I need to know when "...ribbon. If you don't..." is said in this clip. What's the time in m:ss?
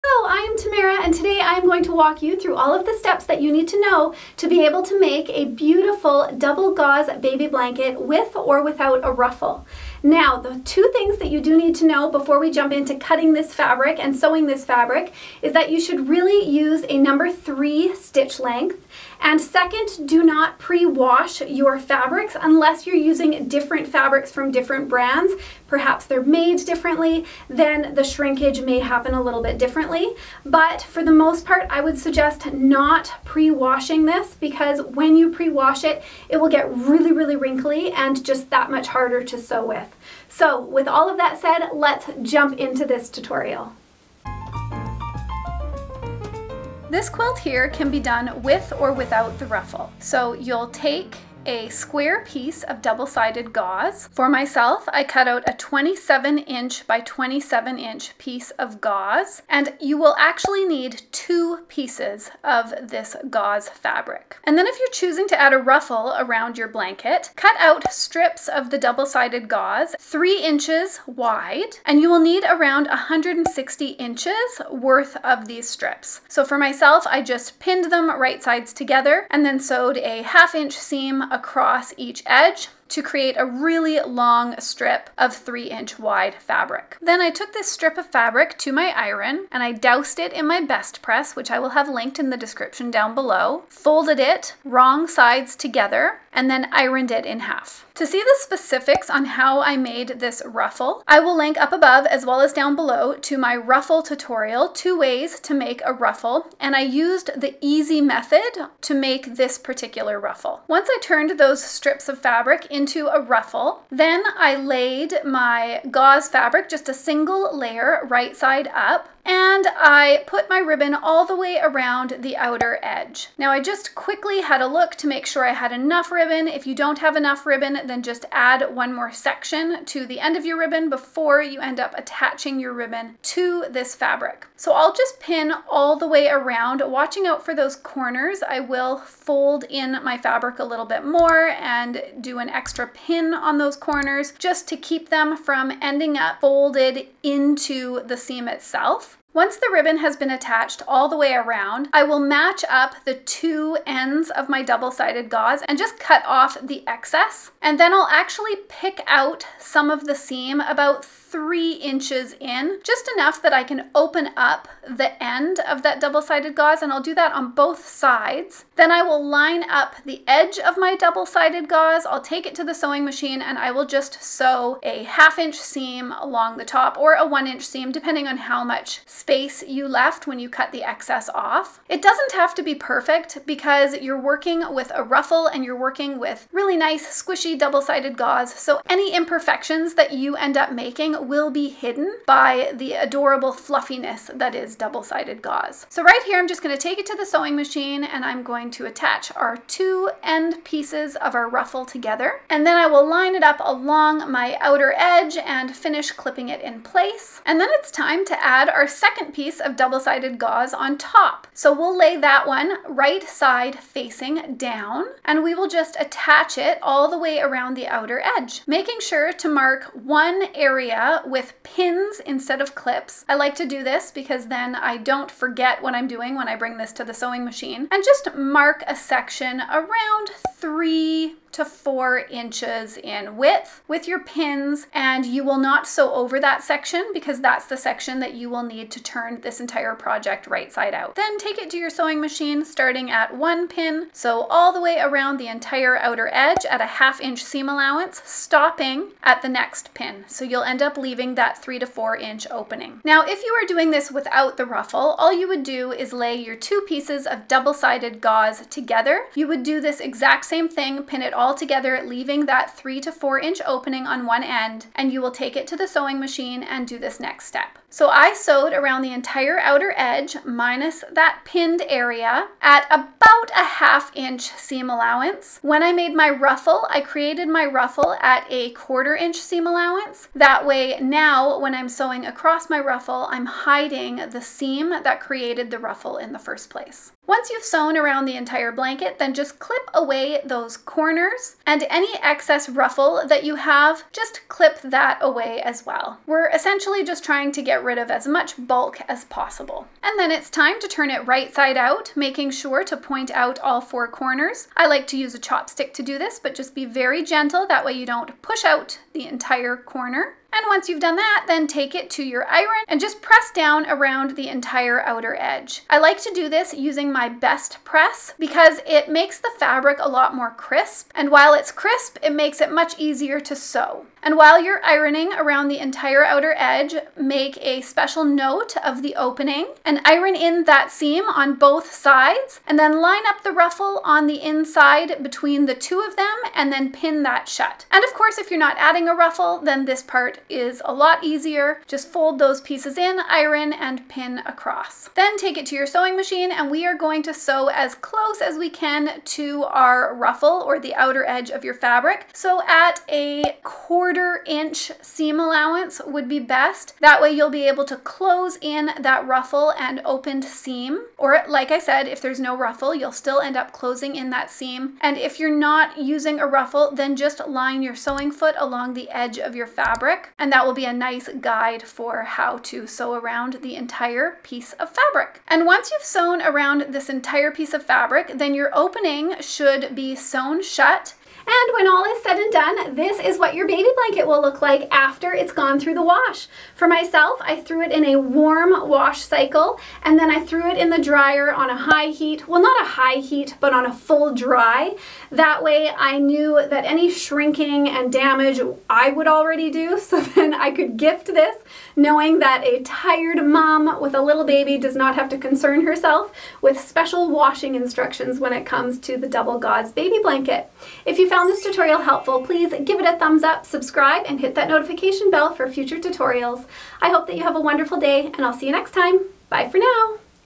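2:06.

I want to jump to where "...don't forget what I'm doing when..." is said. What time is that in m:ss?
3:44.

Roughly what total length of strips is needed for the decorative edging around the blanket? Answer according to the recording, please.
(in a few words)
160 inches.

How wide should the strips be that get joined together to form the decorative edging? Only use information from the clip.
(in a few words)
3 inches.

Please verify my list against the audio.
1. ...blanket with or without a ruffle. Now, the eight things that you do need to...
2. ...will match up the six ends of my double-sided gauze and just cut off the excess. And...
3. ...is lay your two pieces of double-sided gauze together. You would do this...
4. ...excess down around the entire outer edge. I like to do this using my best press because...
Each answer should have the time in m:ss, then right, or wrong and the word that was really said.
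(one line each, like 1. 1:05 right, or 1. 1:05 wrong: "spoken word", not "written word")
1. 0:07 wrong: "two", not "eight"
2. 2:32 wrong: "two", not "six"
3. 4:15 right
4. 5:13 wrong: "press", not "excess".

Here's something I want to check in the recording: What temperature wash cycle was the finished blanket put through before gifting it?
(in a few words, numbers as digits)
warm.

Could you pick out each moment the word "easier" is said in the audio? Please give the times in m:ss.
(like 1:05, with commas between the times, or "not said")
5:22, 5:41.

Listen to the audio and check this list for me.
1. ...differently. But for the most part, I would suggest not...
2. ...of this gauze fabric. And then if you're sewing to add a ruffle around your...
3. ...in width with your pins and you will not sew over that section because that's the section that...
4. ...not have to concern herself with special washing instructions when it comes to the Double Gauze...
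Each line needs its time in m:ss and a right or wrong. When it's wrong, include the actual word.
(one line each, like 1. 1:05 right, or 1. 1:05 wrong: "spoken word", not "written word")
1. 0:29 right
2. 1:02 wrong: "choosing", not "sewing"
3. 3:52 right
4. 6:44 right.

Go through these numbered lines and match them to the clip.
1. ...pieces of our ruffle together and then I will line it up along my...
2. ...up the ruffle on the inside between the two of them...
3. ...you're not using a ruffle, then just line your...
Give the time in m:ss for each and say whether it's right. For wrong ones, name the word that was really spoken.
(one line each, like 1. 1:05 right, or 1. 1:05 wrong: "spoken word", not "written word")
1. 3:20 right
2. 5:33 right
3. 6:05 right.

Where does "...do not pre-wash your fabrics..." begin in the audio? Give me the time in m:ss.
0:20.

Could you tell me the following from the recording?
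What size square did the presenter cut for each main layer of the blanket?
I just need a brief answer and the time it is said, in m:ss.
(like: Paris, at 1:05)
27 inches by 27 inches, at 0:55.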